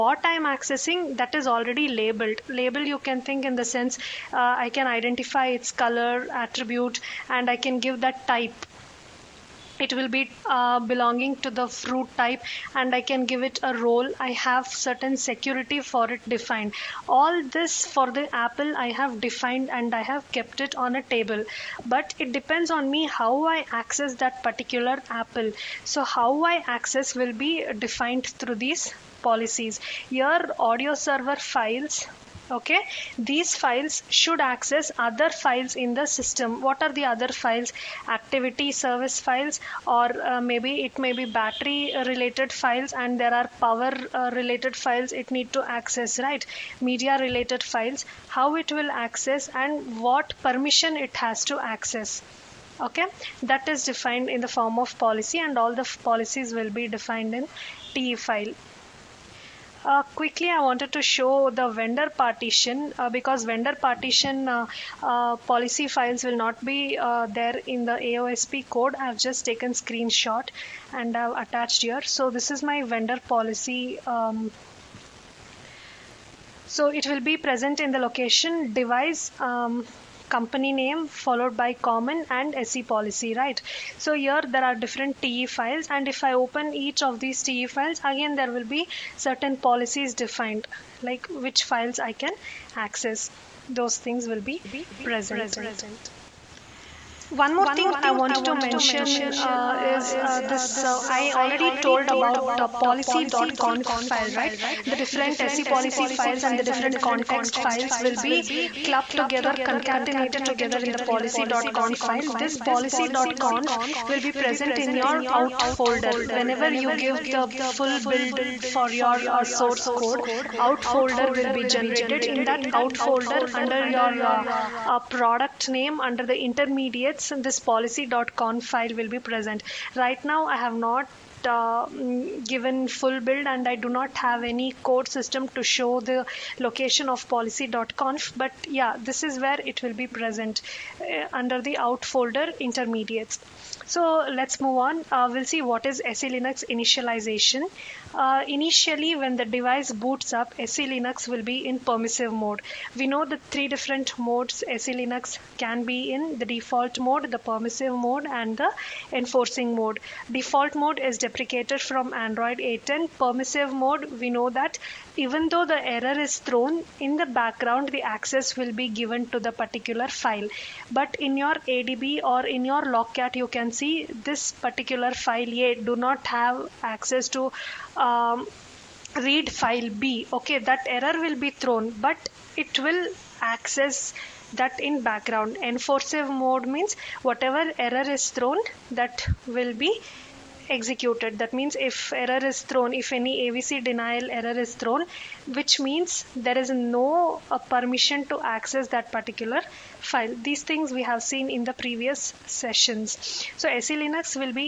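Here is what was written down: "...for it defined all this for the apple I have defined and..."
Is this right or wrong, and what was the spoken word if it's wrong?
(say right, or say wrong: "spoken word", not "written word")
right.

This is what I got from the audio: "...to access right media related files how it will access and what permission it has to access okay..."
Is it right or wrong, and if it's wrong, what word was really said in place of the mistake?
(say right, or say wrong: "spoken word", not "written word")
right.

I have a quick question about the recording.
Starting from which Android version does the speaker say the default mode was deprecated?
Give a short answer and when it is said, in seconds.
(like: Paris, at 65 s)
8.10, at 162 s.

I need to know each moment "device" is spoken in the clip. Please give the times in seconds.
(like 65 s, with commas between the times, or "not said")
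78 s, 149 s.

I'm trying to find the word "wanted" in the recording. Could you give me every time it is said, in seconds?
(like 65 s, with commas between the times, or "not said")
60 s, 98 s.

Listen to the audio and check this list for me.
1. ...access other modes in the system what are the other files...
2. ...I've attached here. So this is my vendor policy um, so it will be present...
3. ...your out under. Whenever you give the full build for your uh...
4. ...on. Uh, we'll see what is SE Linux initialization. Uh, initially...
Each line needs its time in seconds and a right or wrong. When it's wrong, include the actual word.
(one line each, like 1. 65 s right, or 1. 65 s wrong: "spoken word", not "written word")
1. 34 s wrong: "files", not "modes"
2. 71 s right
3. 114 s wrong: "folder", not "under"
4. 144 s right.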